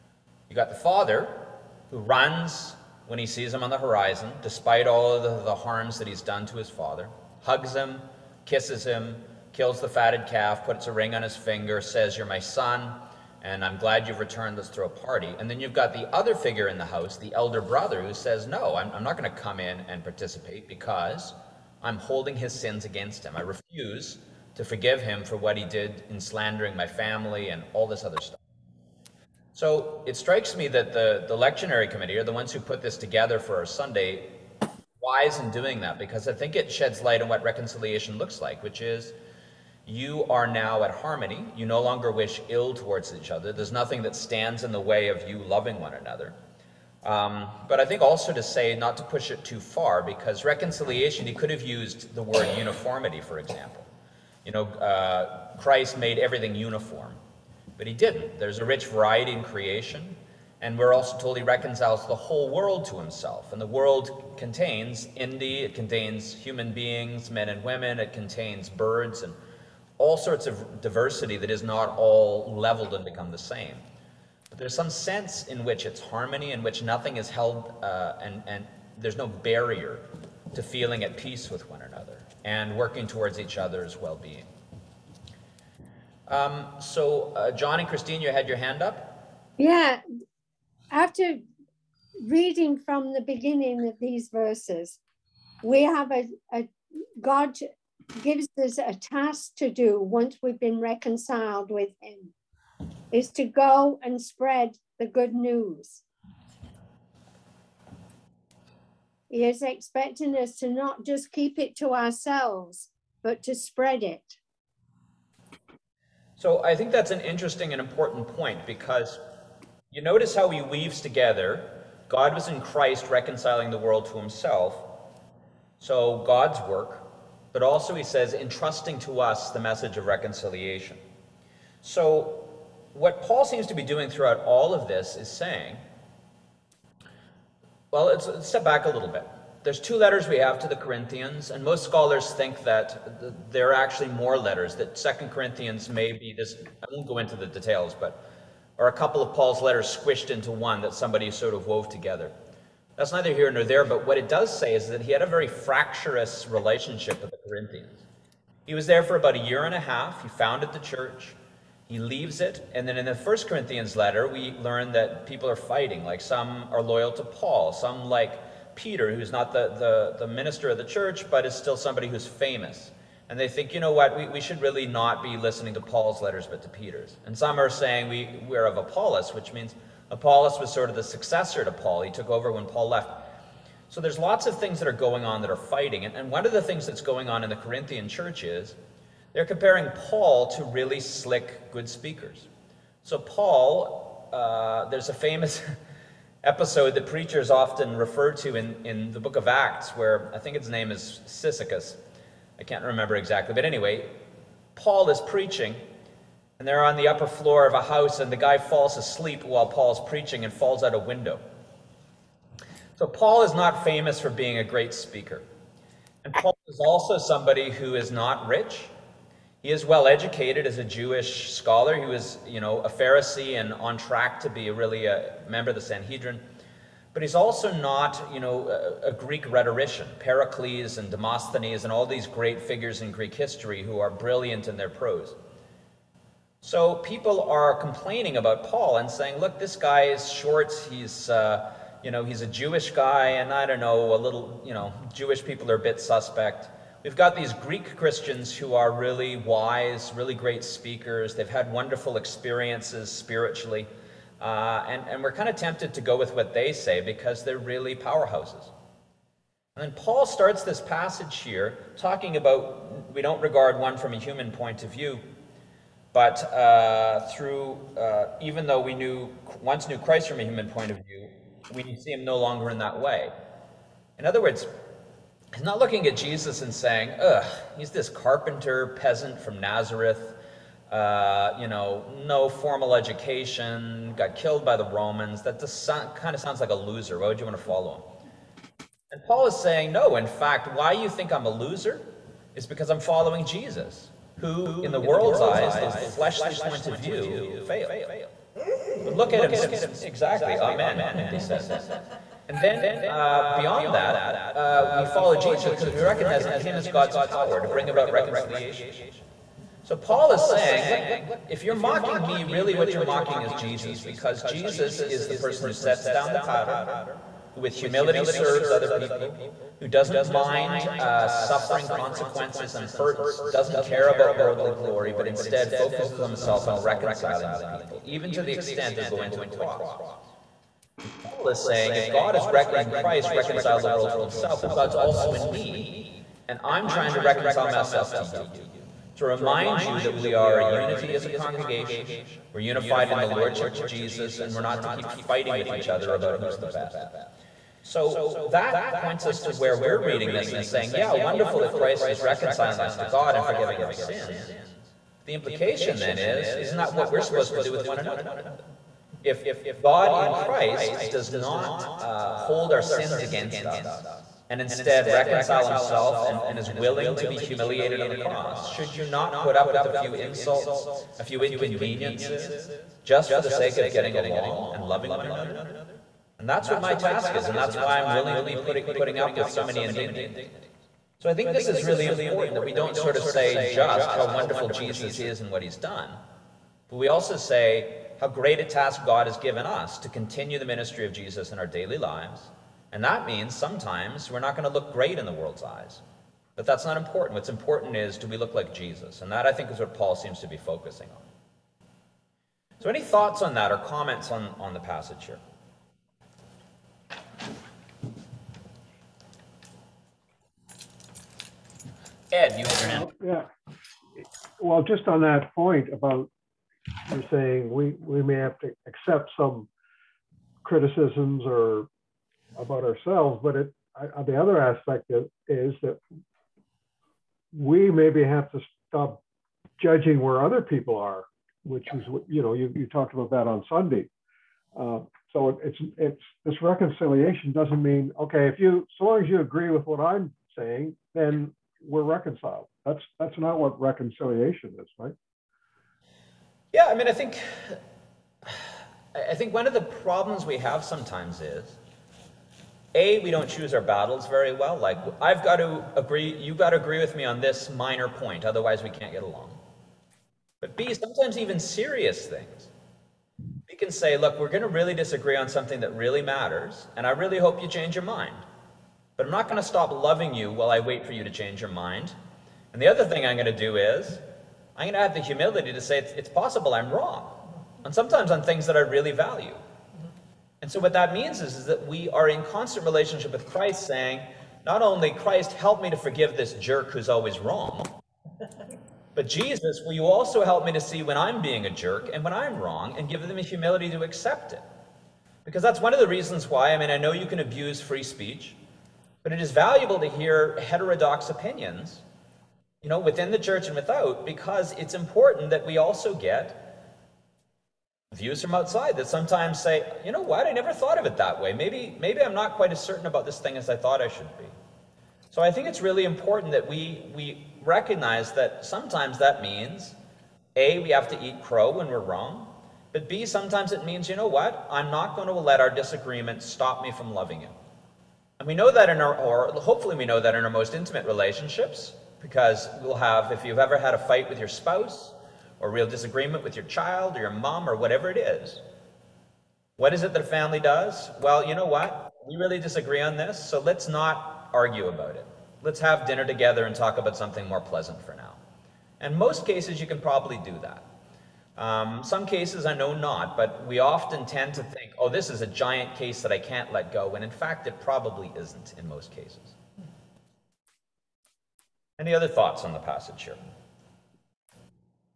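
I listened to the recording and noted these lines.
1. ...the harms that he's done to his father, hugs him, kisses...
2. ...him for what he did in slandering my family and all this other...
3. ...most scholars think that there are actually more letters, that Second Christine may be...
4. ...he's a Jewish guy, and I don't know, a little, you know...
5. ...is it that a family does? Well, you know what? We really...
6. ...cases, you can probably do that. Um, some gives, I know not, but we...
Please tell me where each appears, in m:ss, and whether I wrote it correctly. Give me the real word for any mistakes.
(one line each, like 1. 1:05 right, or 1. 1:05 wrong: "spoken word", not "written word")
1. 0:05 right
2. 0:25 right
3. 2:21 wrong: "Corinthians", not "Christine"
4. 4:02 right
5. 8:59 right
6. 9:09 wrong: "cases", not "gives".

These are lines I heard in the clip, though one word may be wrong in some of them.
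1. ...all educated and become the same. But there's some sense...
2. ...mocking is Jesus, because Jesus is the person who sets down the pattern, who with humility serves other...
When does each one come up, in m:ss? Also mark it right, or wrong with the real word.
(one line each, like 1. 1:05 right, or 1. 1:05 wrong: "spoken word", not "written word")
1. 1:11 wrong: "leveled", not "educated"
2. 5:13 right.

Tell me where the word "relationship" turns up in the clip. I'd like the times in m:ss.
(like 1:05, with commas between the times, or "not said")
2:36, 8:02, 8:51.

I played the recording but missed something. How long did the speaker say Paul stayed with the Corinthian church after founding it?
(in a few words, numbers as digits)
About a year and a half.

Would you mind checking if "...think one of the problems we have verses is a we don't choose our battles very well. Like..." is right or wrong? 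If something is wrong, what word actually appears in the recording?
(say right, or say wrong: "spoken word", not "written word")
wrong: "sometimes", not "verses".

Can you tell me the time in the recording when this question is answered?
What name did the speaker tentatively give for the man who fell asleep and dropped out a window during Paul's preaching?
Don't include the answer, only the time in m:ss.
3:21.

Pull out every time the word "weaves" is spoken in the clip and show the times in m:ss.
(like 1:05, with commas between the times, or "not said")
2:00.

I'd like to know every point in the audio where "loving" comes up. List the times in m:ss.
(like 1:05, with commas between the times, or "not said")
0:45, 6:14, 7:49, 8:47.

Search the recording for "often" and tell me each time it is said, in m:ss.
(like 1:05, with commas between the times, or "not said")
3:17, 9:13.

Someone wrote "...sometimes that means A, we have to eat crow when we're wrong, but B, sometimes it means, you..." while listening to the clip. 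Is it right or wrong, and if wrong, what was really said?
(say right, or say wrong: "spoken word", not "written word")
right.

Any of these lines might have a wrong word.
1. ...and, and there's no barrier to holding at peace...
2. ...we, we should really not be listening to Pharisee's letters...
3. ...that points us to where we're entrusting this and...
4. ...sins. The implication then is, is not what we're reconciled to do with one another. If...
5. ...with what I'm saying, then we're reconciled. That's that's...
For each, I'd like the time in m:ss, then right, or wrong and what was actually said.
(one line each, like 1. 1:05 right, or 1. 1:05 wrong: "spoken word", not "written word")
1. 1:18 wrong: "feeling", not "holding"
2. 2:54 wrong: "Paul", not "Pharisee"
3. 5:48 wrong: "reading", not "entrusting"
4. 5:53 wrong: "supposed", not "reconciled"
5. 7:19 right.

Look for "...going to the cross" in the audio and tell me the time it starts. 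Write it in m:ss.
5:29.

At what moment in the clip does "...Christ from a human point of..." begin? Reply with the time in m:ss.
4:29.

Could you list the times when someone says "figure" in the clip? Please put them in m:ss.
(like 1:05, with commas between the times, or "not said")
0:16, 3:52.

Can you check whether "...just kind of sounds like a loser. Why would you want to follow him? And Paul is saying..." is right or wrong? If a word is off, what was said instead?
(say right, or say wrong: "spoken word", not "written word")
right.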